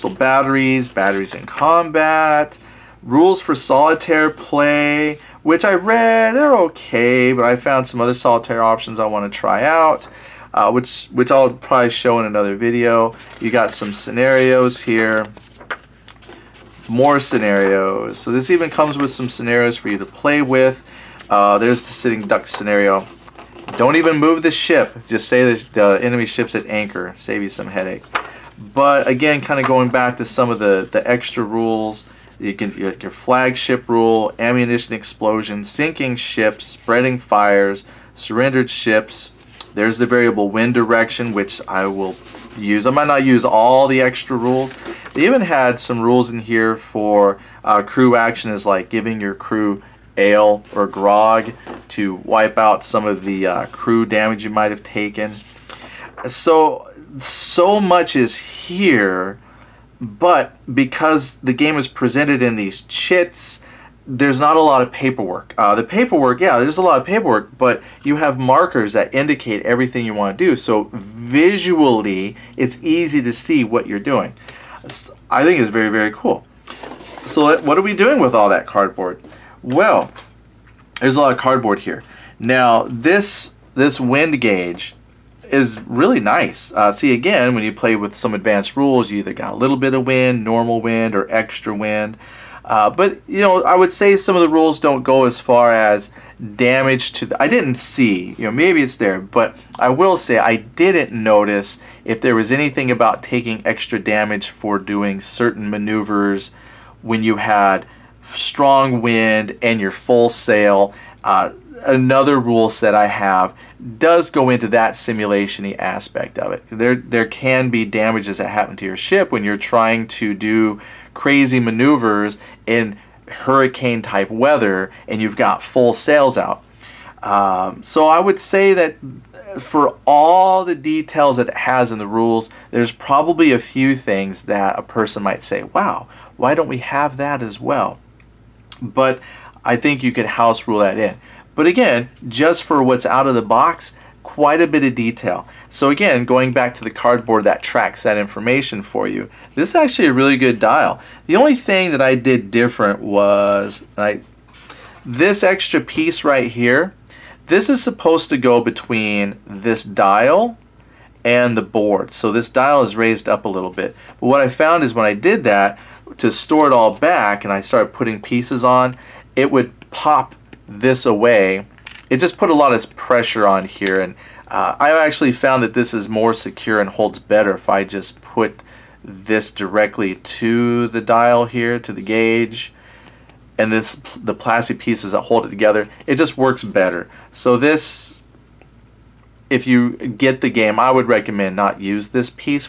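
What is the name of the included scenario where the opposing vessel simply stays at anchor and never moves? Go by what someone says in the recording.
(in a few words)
Sitting duck.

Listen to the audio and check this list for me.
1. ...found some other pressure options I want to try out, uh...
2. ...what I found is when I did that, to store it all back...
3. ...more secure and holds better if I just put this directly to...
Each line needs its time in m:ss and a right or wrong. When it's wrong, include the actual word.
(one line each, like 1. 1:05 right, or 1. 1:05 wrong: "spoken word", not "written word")
1. 0:07 wrong: "solitaire", not "pressure"
2. 2:44 right
3. 2:56 right.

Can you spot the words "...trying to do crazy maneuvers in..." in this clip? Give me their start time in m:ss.
1:59.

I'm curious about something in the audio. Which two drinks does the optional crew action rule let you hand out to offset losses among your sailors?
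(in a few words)
Ale or grog.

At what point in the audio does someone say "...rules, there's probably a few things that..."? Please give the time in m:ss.
2:12.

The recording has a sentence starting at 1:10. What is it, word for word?
So visually, it's easy to see what you're doing.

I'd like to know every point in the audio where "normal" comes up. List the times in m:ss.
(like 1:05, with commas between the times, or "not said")
1:30.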